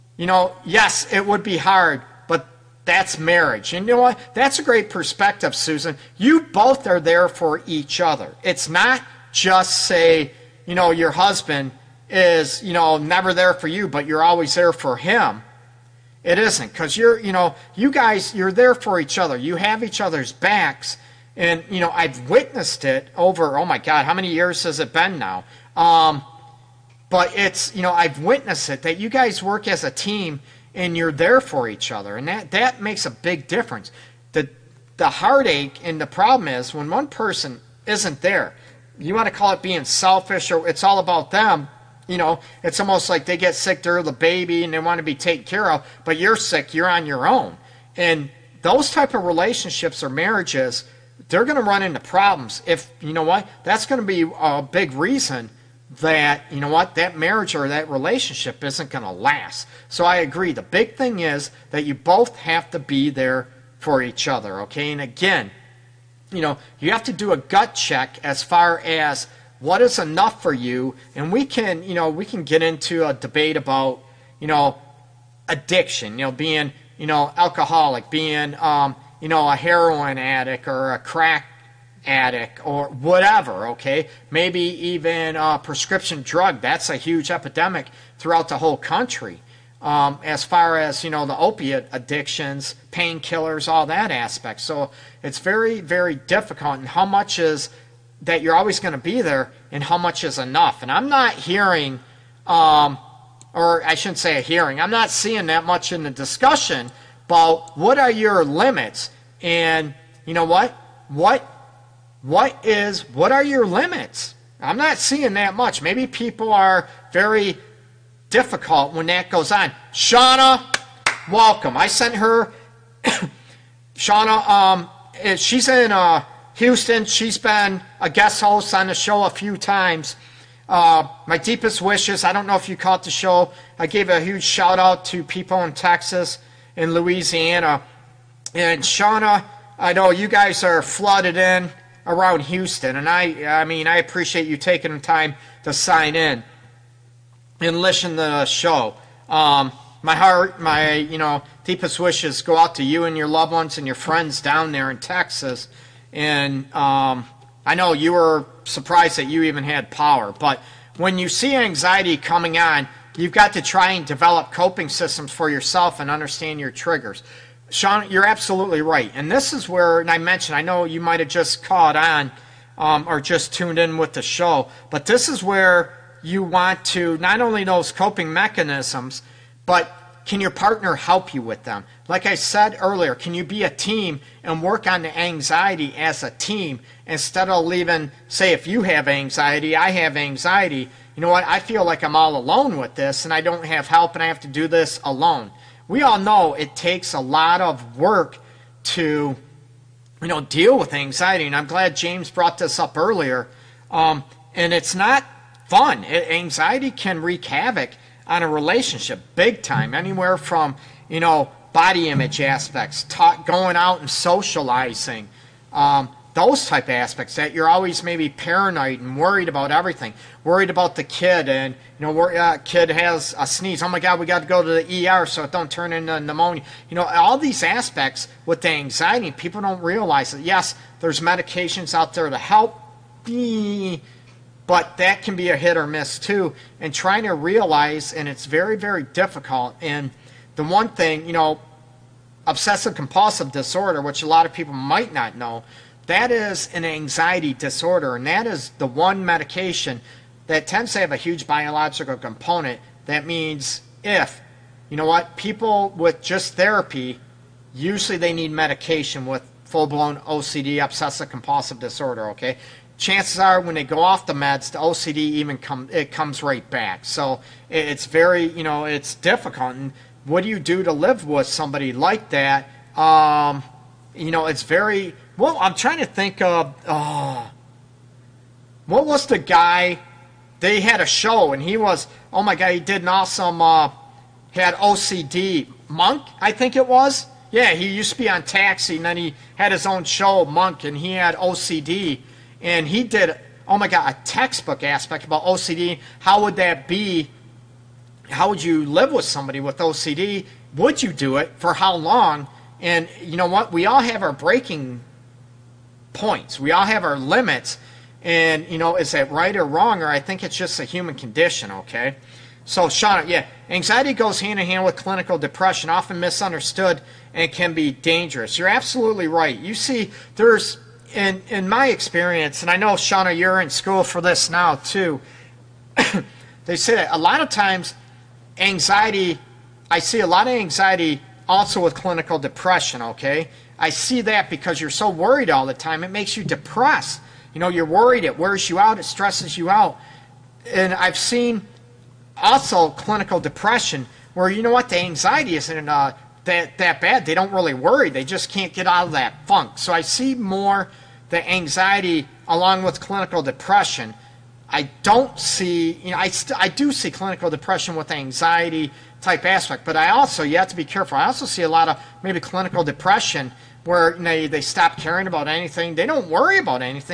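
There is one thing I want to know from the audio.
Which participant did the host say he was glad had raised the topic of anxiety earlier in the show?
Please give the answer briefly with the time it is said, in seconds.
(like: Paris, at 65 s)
James, at 201 s.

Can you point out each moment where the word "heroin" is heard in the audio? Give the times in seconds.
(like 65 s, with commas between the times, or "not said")
79 s.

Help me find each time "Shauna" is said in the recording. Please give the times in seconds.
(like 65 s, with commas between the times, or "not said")
119 s, 123 s, 138 s, 322 s.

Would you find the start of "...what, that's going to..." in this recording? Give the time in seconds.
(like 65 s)
53 s.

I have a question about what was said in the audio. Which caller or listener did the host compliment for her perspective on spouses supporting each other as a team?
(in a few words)
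Susan.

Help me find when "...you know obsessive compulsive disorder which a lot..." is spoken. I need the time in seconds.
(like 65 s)
241 s.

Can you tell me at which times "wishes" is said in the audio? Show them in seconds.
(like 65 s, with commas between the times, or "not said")
131 s, 151 s.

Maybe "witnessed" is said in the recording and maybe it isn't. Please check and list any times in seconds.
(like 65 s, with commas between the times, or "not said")
22 s, 28 s.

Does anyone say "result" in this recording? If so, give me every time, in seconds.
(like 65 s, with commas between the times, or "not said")
not said.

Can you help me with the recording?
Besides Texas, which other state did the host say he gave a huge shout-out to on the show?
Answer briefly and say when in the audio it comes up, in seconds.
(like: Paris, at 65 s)
Louisiana, at 136 s.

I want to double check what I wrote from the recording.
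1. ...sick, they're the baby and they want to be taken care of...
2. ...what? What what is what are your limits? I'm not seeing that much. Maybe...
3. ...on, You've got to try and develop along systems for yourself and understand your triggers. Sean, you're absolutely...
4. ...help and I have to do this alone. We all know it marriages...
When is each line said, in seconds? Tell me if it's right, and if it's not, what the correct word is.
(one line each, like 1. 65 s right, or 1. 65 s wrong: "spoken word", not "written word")
1. 43 s right
2. 110 s right
3. 162 s wrong: "coping", not "along"
4. 193 s wrong: "takes", not "marriages".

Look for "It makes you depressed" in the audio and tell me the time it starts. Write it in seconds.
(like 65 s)
336 s.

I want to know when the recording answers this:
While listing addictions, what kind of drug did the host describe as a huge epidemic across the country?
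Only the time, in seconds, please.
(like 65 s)
85 s.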